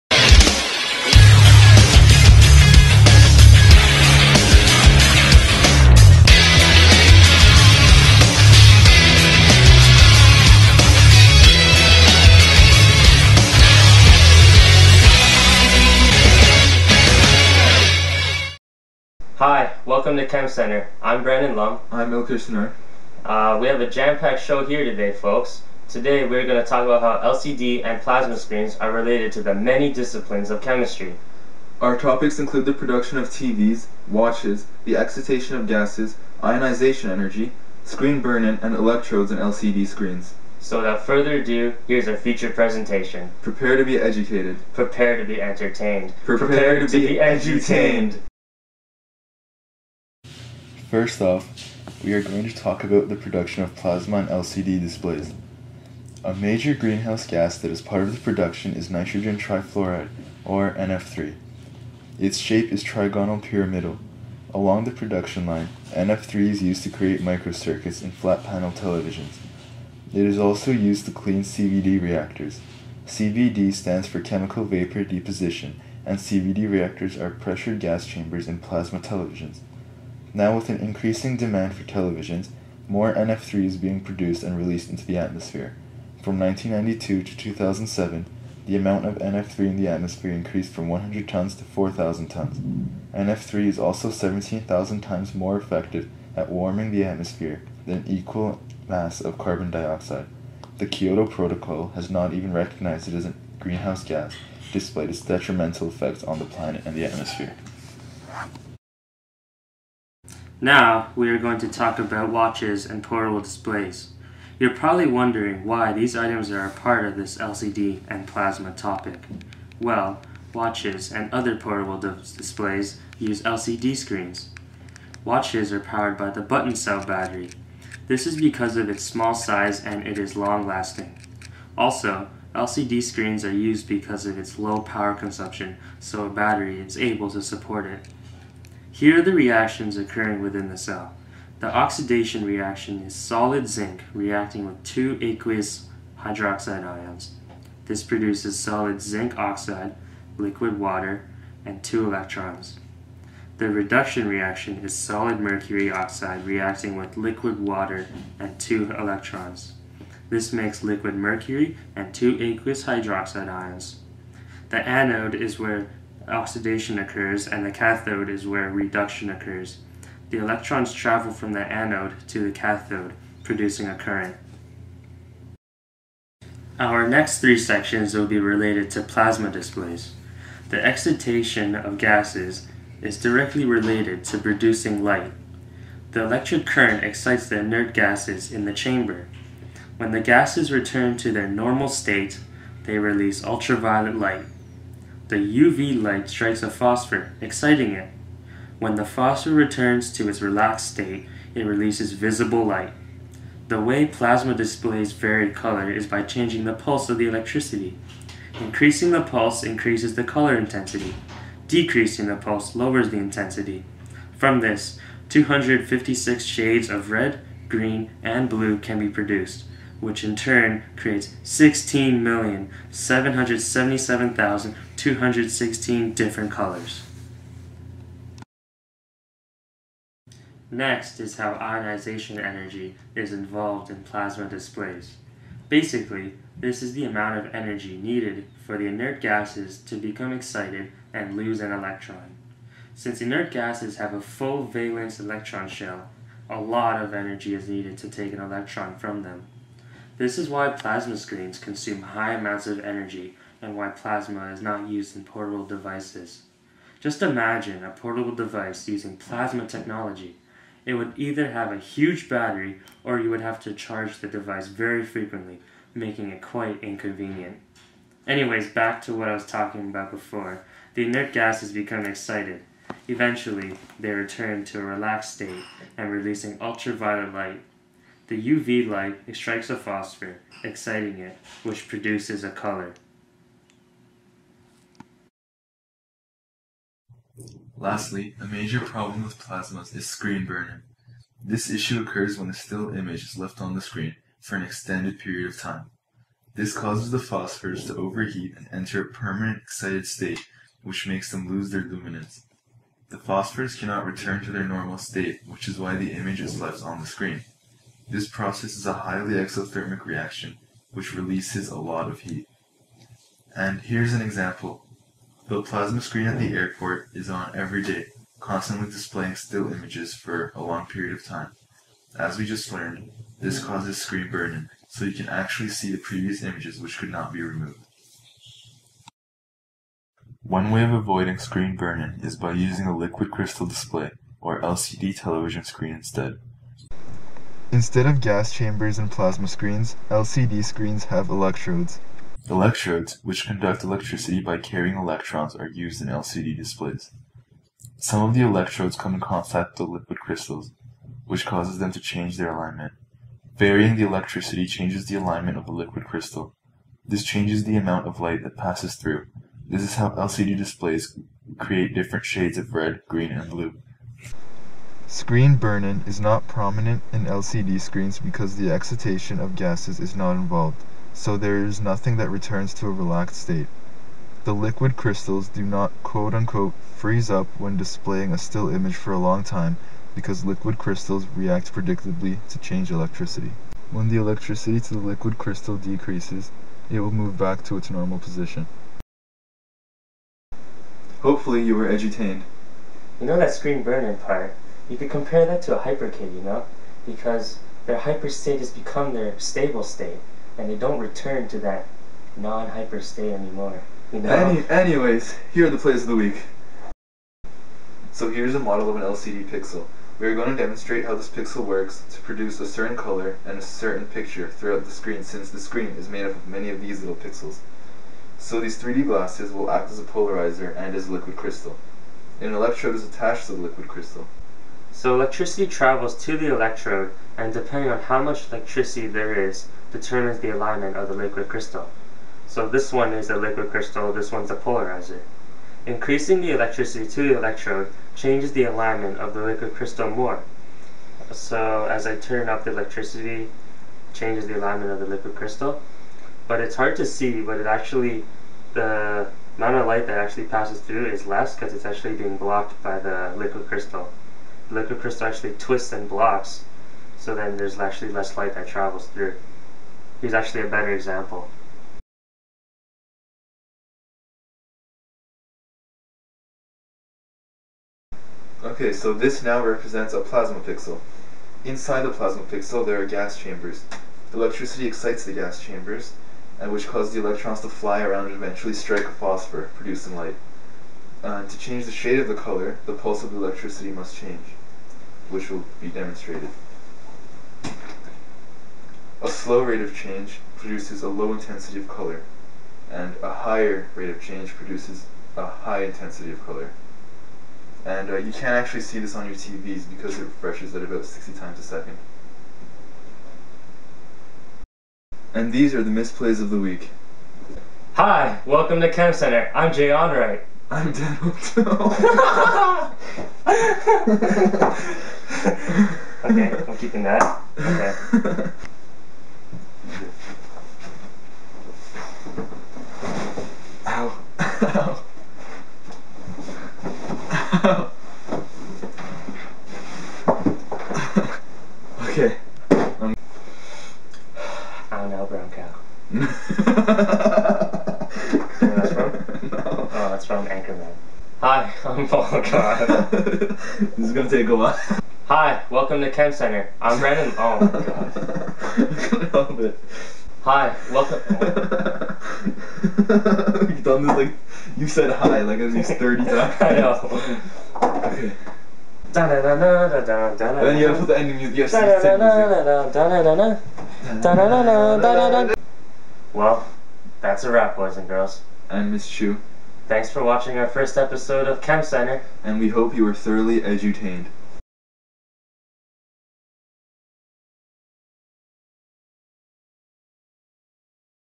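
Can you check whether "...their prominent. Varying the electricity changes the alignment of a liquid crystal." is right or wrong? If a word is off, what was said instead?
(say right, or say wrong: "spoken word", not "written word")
wrong: "alignment", not "prominent".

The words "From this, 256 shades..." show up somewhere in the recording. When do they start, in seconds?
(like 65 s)
214 s.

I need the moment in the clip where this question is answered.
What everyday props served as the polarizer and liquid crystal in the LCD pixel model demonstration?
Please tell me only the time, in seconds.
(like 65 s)
418 s.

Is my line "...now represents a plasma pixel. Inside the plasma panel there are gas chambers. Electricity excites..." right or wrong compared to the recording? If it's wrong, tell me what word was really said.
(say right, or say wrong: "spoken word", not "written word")
wrong: "pixel", not "panel".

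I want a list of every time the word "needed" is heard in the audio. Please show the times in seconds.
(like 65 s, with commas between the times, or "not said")
237 s, 247 s.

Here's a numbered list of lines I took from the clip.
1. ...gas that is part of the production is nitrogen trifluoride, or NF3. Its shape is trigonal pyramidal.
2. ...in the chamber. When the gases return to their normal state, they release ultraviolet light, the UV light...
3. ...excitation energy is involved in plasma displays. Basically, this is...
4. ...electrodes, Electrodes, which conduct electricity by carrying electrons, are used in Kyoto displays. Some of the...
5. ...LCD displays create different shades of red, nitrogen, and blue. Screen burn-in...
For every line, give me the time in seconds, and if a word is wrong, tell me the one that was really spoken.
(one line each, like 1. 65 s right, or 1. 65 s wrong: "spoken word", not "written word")
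1. 57 s right
2. 188 s right
3. 231 s wrong: "ionization", not "excitation"
4. 341 s wrong: "LCD", not "Kyoto"
5. 360 s wrong: "green", not "nitrogen".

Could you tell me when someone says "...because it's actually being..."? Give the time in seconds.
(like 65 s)
451 s.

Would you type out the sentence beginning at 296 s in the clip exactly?
This causes the phosphors to overheat and enter a permanent excited state, which makes them lose their luminance.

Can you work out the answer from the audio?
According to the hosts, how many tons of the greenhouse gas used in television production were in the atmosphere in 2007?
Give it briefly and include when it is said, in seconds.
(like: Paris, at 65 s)
4,000 tons, at 91 s.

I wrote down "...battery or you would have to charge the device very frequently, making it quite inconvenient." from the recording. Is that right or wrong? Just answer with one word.
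right.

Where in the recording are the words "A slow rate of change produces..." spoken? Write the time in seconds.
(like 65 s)
489 s.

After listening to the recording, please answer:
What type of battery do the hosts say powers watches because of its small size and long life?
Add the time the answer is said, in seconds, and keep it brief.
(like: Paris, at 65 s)
button cell battery, at 126 s.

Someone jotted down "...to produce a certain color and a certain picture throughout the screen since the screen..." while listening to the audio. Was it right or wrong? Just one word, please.
right.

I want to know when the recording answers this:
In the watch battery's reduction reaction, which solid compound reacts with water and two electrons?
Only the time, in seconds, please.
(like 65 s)
154 s.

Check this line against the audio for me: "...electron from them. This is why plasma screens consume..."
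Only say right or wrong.
right.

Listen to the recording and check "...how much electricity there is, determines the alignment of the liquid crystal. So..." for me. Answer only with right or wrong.
right.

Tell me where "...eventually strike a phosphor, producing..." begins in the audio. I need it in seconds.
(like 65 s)
478 s.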